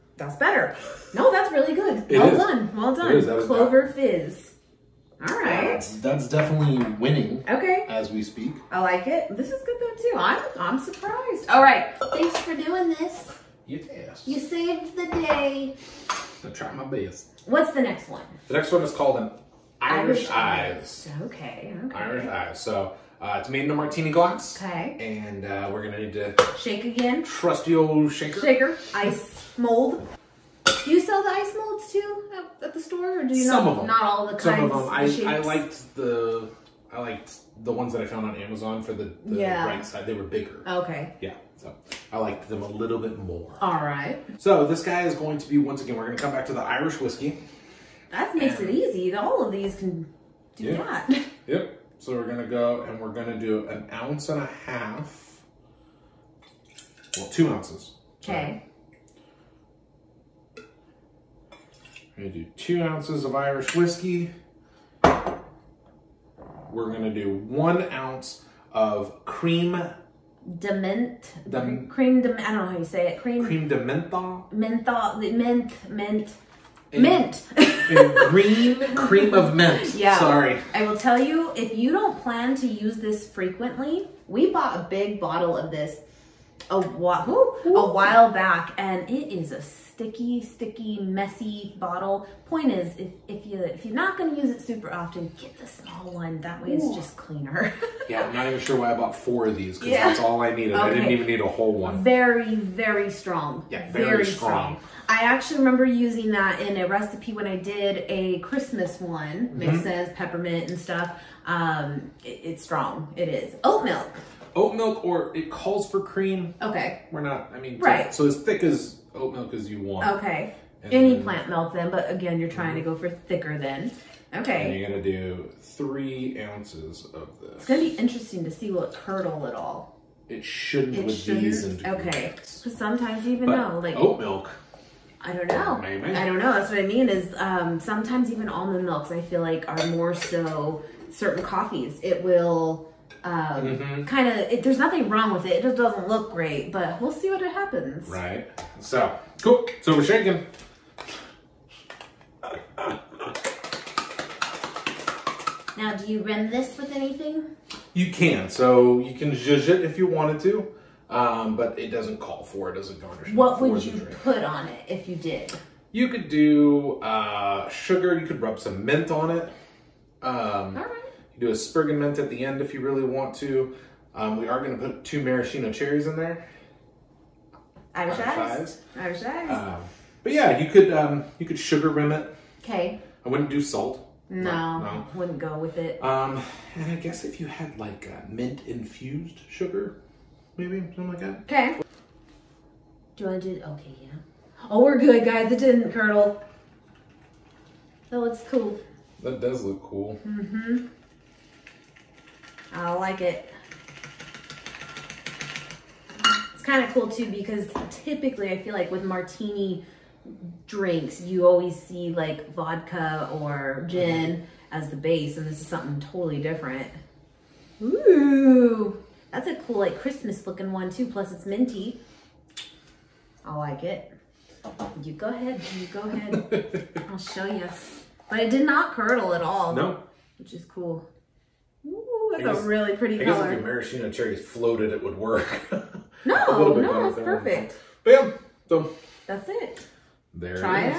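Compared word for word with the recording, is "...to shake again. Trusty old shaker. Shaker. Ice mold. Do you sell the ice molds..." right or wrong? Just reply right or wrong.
right.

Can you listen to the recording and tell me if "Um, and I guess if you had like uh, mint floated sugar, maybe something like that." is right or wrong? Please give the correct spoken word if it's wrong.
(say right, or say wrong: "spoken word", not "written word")
wrong: "infused", not "floated".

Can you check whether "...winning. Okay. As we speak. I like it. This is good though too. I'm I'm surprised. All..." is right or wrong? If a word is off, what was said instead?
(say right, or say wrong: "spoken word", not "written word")
right.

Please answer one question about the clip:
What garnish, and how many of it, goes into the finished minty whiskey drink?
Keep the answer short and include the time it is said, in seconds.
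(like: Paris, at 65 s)
2 maraschino cherries, at 175 s.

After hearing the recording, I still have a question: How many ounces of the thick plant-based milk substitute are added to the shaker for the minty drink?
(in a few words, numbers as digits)
3 ounces.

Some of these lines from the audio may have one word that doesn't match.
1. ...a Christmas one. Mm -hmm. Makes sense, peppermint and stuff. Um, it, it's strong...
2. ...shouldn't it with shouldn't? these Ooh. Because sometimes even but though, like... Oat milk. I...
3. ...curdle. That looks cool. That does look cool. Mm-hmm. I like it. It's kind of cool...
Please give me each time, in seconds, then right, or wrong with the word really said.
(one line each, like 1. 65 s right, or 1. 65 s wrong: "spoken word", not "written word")
1. 108 s right
2. 130 s wrong: "Okay", not "Ooh"
3. 195 s right.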